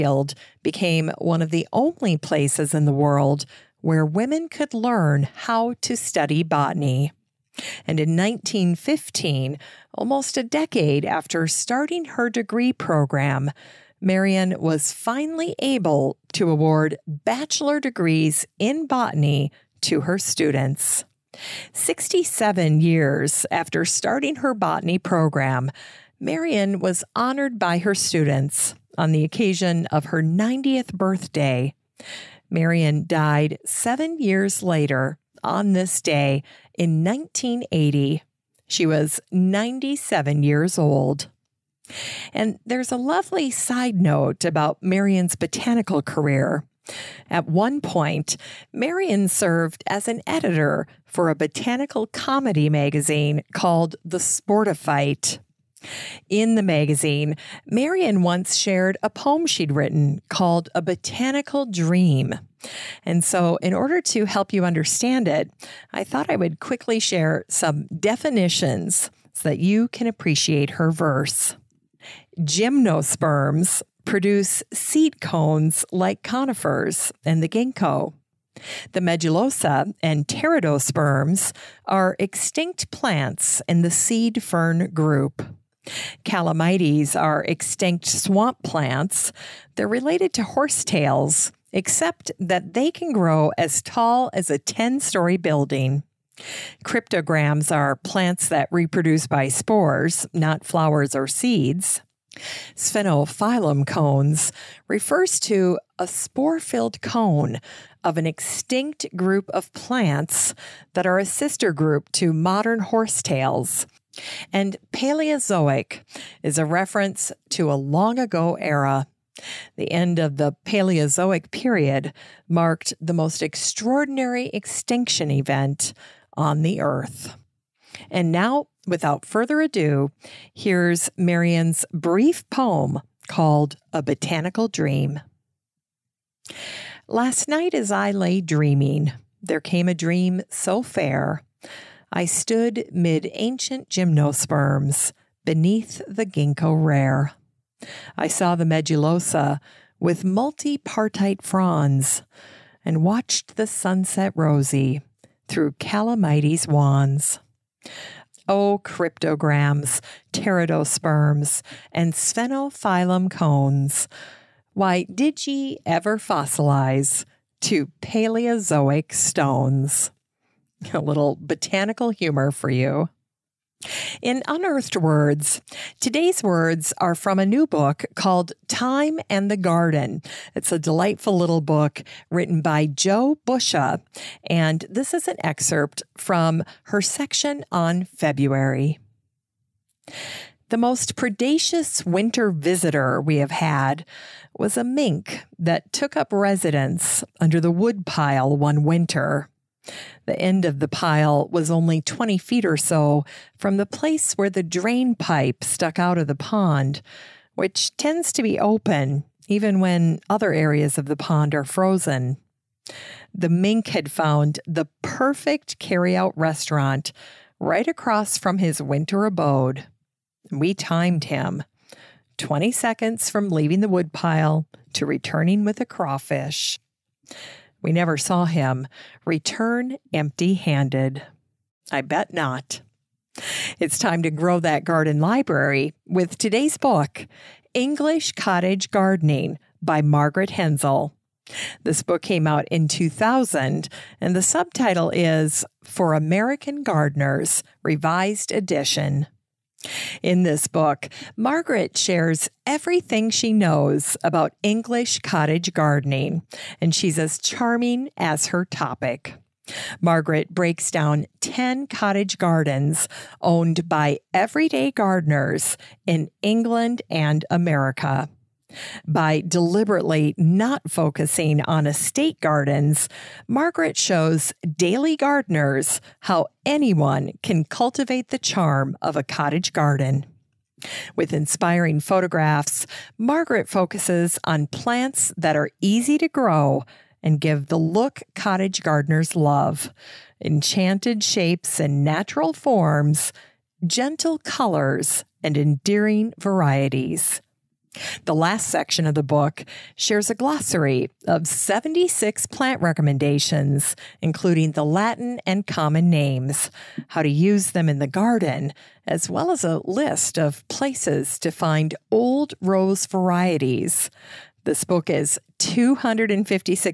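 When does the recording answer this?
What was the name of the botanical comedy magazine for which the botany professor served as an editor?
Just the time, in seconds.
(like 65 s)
54 s.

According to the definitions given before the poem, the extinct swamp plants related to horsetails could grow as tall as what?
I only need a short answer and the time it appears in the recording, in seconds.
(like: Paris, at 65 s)
a 10 story building, at 94 s.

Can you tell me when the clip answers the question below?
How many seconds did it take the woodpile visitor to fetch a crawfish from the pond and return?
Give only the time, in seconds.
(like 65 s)
222 s.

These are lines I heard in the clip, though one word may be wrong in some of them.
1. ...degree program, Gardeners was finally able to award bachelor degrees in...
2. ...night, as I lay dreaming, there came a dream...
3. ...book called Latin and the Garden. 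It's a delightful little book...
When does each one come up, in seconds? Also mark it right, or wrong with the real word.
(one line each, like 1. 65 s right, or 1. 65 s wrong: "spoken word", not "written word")
1. 12 s wrong: "Marion", not "Gardeners"
2. 137 s right
3. 177 s wrong: "Time", not "Latin".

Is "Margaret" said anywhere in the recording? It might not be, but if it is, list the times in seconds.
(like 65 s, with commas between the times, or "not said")
240 s, 251 s, 259 s, 273 s, 283 s.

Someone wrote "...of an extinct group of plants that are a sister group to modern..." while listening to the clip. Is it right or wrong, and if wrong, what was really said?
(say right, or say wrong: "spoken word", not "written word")
right.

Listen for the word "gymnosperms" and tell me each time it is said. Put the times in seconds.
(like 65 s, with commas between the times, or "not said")
72 s, 143 s.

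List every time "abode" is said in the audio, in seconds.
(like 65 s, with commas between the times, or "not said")
219 s.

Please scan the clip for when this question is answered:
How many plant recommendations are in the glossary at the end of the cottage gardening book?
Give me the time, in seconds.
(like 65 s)
301 s.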